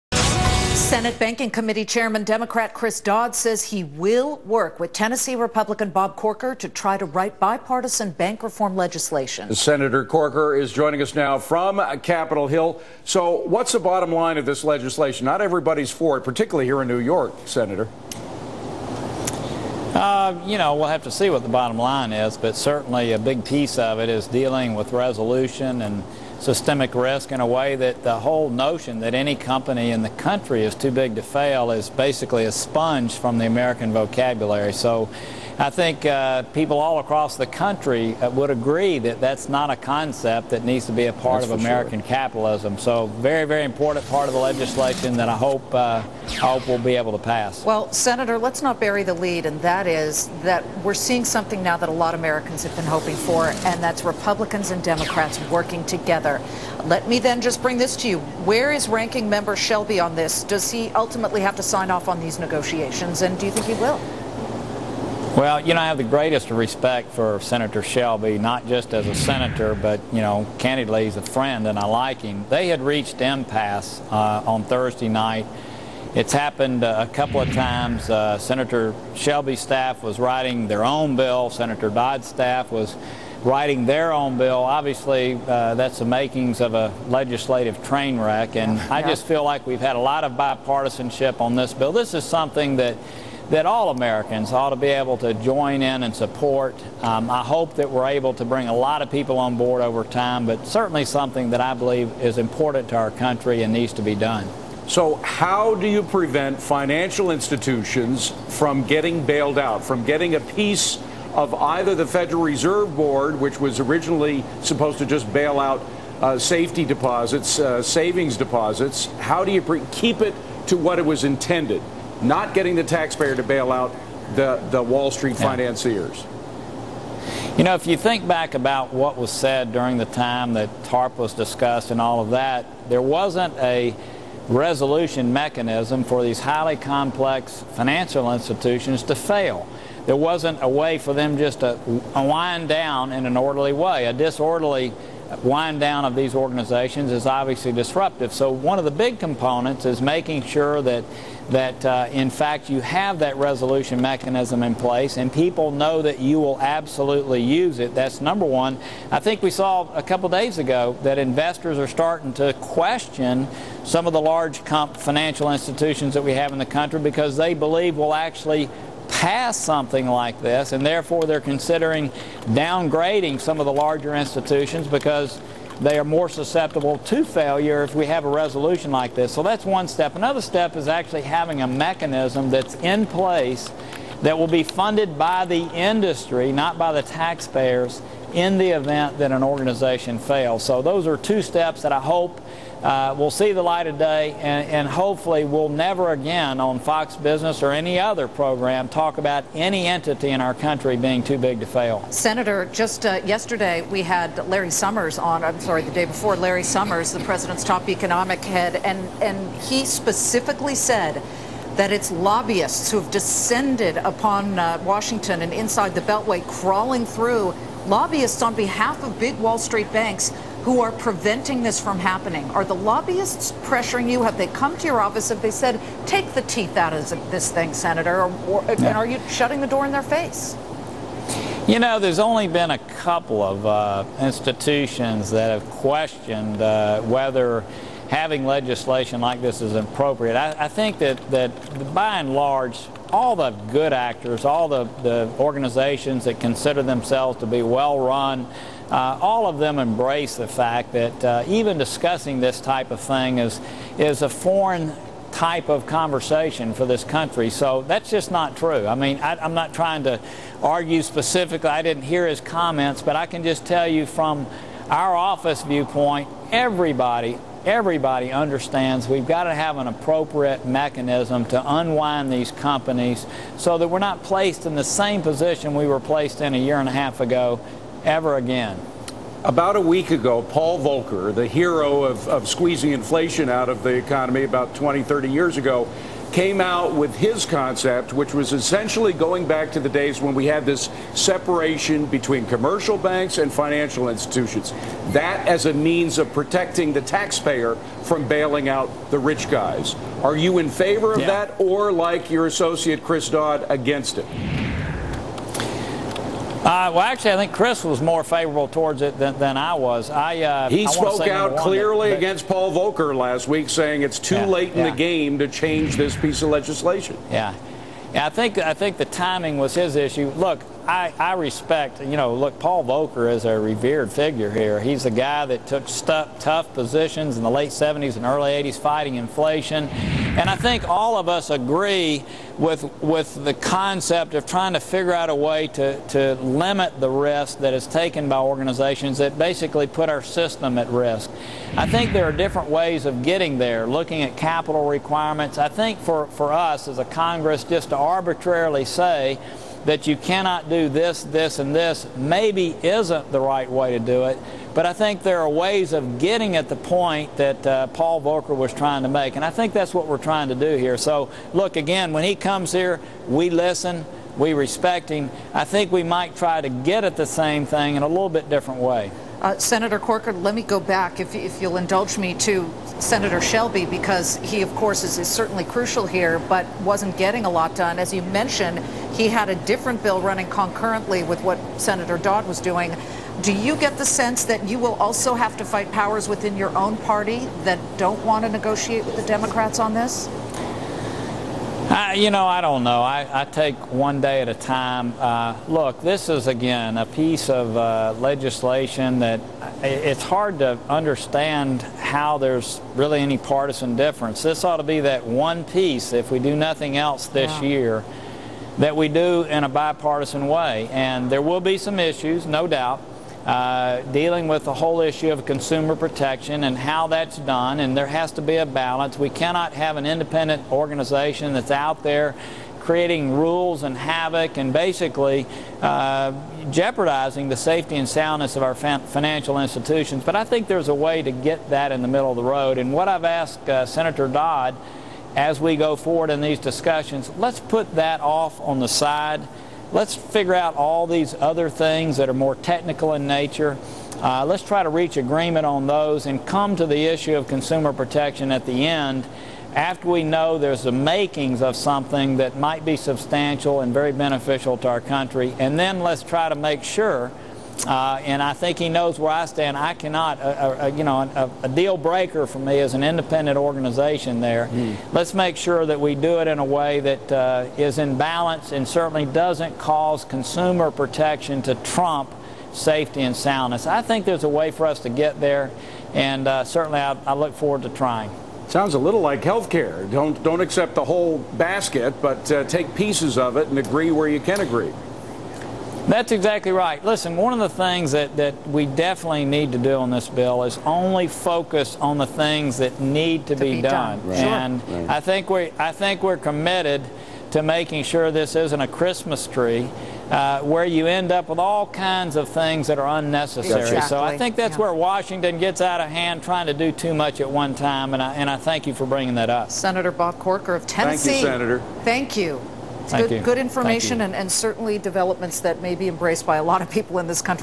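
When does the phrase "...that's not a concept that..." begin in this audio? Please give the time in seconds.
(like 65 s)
39 s.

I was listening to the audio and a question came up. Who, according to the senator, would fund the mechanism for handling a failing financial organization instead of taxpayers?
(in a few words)
the industry.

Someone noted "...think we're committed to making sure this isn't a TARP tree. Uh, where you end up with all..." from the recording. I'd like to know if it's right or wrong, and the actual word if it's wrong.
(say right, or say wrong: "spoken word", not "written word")
wrong: "Christmas", not "TARP".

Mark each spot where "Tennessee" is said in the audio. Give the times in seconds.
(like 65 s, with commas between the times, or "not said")
4 s, 510 s.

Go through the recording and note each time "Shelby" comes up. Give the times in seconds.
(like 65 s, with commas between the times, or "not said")
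59 s, 67 s, 79 s, 373 s.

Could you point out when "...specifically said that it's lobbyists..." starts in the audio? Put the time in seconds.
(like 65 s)
209 s.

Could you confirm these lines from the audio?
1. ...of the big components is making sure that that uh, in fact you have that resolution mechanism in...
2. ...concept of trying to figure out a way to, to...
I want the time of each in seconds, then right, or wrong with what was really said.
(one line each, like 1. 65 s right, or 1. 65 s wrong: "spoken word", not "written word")
1. 148 s right
2. 333 s right.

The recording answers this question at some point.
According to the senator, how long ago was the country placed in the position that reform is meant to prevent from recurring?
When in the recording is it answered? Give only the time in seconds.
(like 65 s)
276 s.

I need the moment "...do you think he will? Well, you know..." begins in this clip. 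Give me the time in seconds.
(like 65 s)
63 s.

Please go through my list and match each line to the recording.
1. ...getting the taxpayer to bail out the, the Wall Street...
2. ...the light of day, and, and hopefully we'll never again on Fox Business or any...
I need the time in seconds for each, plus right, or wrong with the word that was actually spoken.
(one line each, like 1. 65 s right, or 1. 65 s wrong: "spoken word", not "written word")
1. 122 s right
2. 193 s right.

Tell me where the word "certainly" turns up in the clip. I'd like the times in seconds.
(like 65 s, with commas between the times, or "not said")
22 s, 100 s, 375 s, 468 s, 476 s, 514 s.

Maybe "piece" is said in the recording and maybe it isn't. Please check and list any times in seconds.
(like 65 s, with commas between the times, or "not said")
23 s, 110 s, 316 s, 397 s, 405 s, 482 s.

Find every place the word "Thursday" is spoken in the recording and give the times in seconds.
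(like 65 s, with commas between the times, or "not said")
74 s.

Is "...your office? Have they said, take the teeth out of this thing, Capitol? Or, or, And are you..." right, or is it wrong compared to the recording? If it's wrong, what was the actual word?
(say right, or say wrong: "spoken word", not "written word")
wrong: "Senator", not "Capitol".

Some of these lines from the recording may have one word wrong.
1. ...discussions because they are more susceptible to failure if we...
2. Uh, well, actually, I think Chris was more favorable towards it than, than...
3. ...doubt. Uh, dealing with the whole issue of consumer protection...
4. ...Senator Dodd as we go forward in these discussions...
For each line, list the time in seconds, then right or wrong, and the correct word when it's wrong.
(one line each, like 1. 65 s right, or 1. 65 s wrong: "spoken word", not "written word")
1. 174 s wrong: "institutions", not "discussions"
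2. 306 s right
3. 412 s right
4. 433 s right.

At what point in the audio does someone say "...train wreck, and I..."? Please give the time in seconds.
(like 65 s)
87 s.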